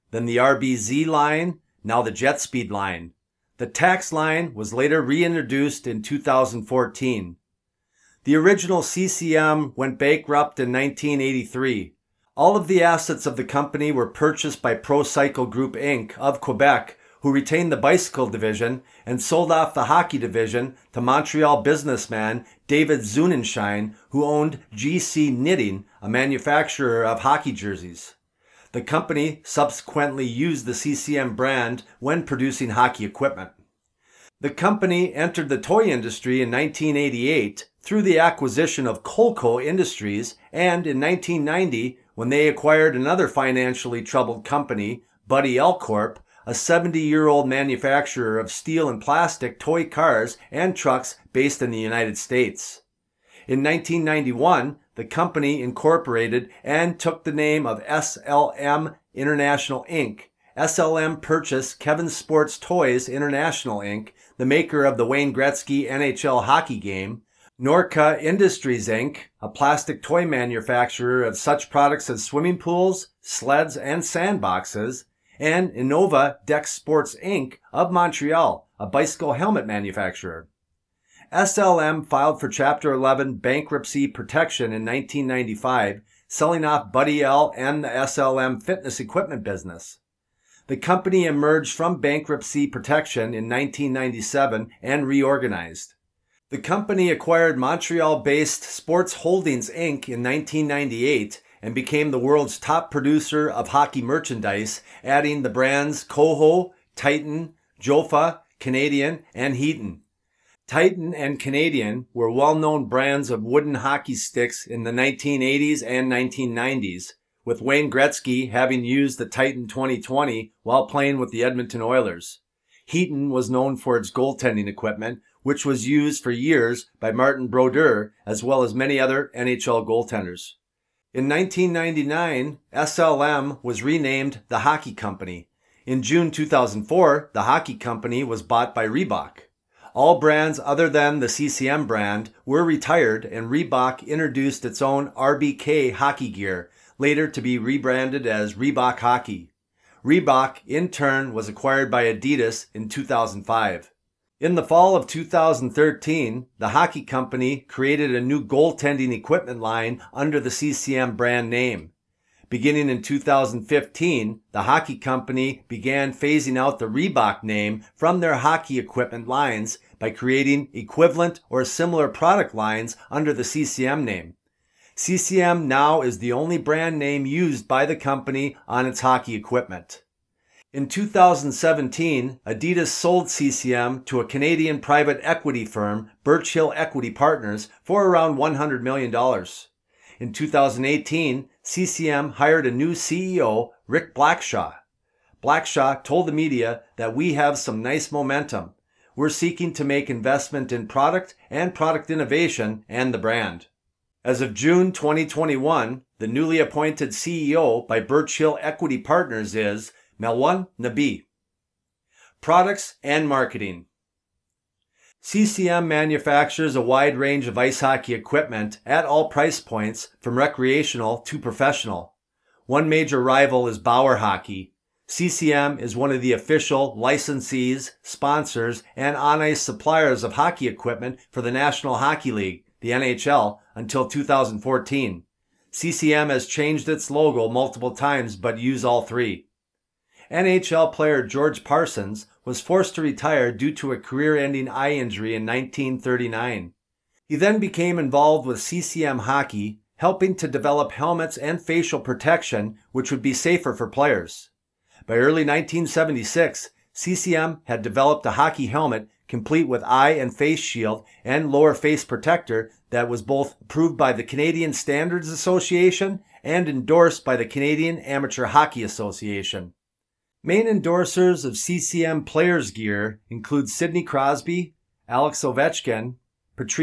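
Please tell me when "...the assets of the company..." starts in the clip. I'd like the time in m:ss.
0:12.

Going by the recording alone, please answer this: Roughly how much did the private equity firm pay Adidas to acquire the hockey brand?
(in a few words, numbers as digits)
$100 million.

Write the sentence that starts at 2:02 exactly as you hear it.
Heaton was known for its goaltending equipment, which was used for years by Martin Brodeur as well as many other NHL goaltenders.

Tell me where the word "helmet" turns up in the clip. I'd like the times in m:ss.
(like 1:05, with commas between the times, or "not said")
1:19, 4:10, 4:18.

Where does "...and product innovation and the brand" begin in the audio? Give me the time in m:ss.
3:21.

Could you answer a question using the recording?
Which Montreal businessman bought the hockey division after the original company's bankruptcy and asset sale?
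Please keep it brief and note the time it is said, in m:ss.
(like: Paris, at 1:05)
David Zunenshine, at 0:22.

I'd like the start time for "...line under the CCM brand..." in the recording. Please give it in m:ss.
2:39.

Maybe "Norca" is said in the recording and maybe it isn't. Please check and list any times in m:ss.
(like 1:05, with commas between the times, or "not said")
1:07.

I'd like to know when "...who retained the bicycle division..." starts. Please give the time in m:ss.
0:17.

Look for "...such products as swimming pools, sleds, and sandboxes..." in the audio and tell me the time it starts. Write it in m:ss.
1:11.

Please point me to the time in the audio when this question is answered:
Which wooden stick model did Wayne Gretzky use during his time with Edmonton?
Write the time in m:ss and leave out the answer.
1:59.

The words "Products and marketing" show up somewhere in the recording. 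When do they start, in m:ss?
3:32.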